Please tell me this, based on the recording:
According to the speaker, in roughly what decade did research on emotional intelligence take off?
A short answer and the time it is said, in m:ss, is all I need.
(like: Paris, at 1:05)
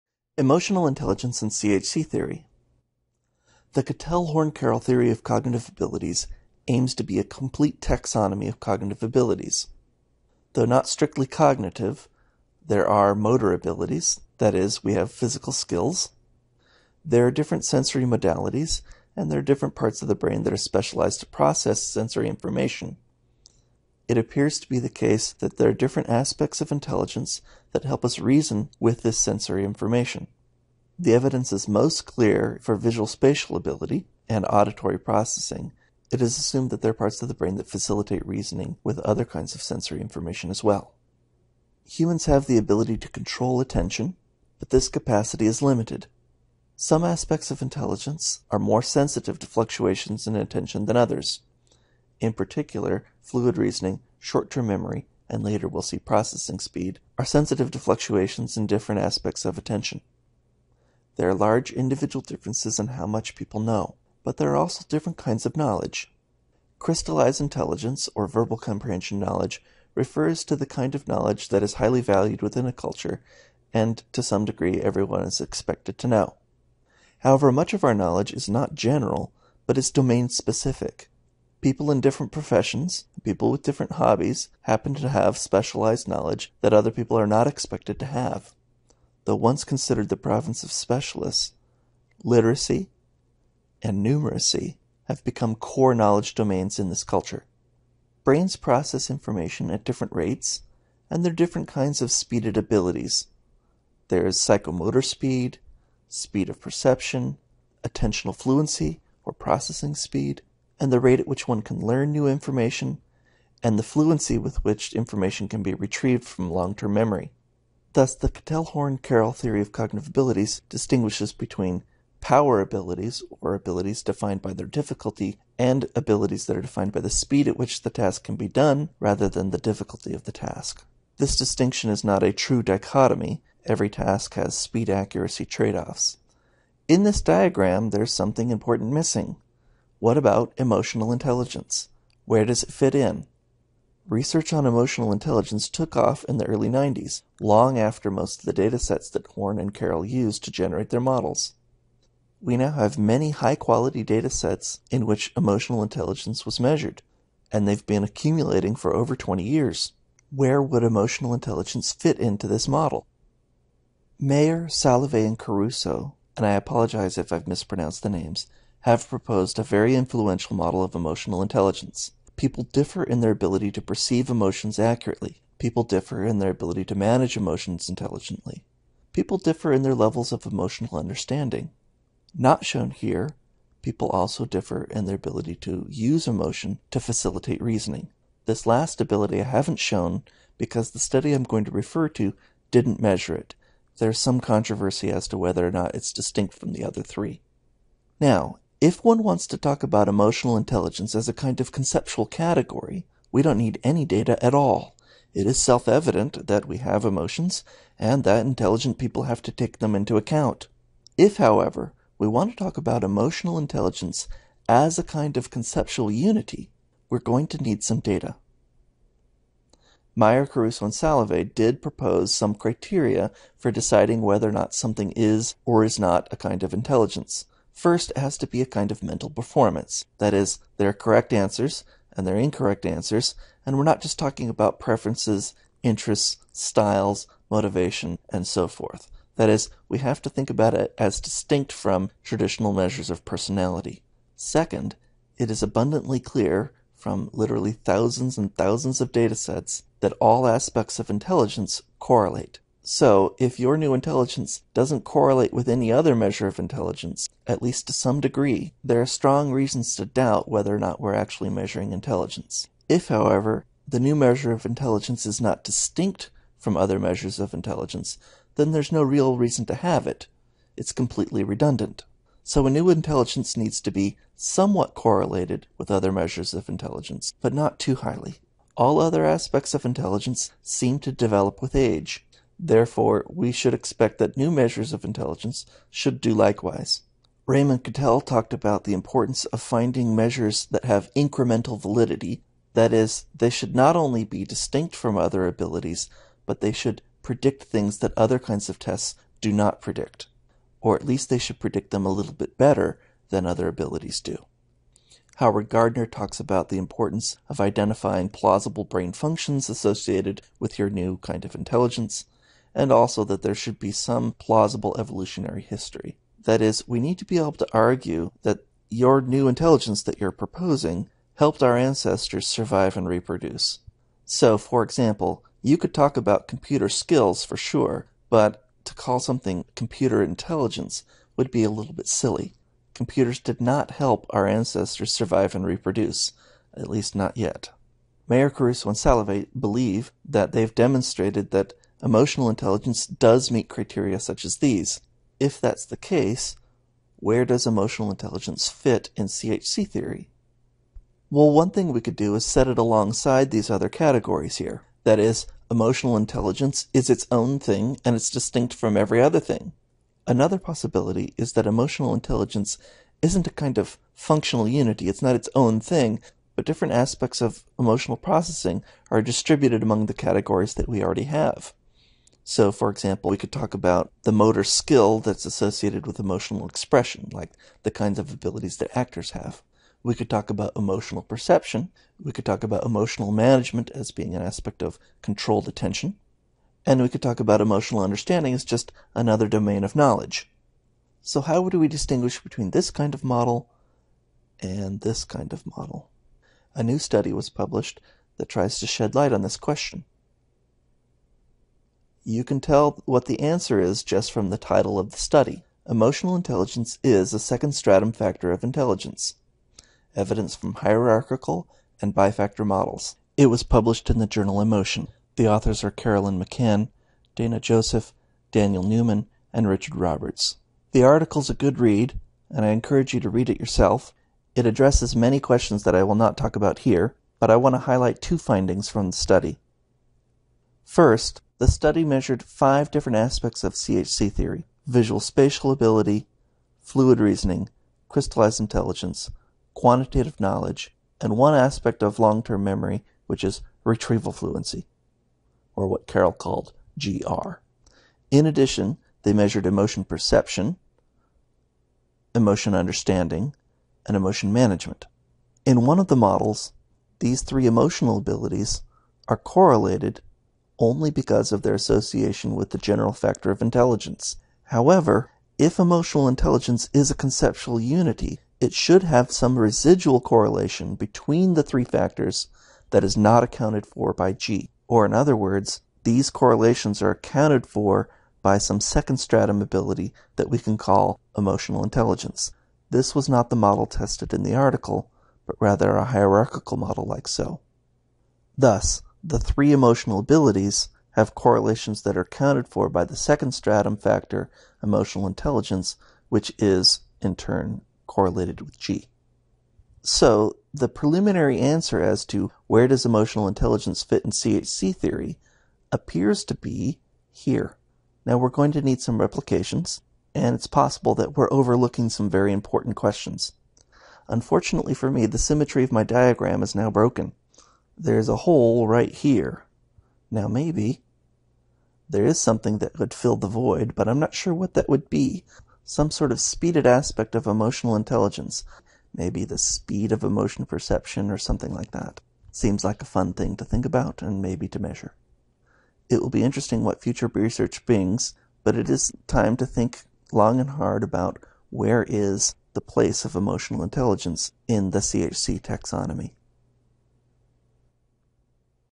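early 90s, at 2:26.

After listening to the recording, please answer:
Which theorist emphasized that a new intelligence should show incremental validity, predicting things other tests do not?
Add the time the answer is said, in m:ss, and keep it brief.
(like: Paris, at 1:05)
Raymond Cattell, at 4:47.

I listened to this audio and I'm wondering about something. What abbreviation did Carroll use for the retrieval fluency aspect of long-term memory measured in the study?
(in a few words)
GR.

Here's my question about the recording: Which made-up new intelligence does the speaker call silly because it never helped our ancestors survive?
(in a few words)
computer intelligence.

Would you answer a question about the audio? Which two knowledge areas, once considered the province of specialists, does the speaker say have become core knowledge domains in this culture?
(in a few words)
literacy and numeracy.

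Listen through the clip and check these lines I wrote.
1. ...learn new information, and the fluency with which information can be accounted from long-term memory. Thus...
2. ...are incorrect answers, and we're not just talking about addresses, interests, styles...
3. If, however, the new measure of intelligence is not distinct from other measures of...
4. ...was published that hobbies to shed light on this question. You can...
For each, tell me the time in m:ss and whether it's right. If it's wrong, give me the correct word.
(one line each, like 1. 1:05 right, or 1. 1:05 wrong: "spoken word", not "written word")
1. 1:51 wrong: "retrieved", not "accounted"
2. 3:52 wrong: "preferences", not "addresses"
3. 4:22 right
4. 6:37 wrong: "tries", not "hobbies".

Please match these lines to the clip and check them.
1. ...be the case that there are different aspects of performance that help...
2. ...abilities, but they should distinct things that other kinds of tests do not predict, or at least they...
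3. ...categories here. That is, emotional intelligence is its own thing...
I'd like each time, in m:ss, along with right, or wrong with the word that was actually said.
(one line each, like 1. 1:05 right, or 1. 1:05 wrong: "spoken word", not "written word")
1. 0:24 wrong: "intelligence", not "performance"
2. 4:55 wrong: "predict", not "distinct"
3. 5:53 right.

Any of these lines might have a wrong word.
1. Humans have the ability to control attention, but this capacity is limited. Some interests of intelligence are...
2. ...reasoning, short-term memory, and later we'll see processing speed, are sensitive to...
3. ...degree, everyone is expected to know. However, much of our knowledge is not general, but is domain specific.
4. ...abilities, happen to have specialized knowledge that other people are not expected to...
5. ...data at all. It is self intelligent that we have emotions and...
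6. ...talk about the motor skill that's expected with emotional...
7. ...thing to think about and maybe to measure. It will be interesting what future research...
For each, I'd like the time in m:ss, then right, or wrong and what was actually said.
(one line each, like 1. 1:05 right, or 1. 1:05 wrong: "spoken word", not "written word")
1. 0:41 wrong: "aspects", not "interests"
2. 0:53 right
3. 1:14 right
4. 1:23 wrong: "hobbies", not "abilities"
5. 3:24 wrong: "evident", not "intelligent"
6. 6:13 wrong: "associated", not "expected"
7. 8:53 right.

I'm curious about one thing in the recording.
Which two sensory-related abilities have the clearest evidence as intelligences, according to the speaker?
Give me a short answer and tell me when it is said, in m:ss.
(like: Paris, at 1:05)
visual spatial ability and auditory processing, at 0:32.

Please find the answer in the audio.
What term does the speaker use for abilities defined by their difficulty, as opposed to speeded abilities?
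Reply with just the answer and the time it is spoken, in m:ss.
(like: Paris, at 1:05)
power abilities, at 2:02.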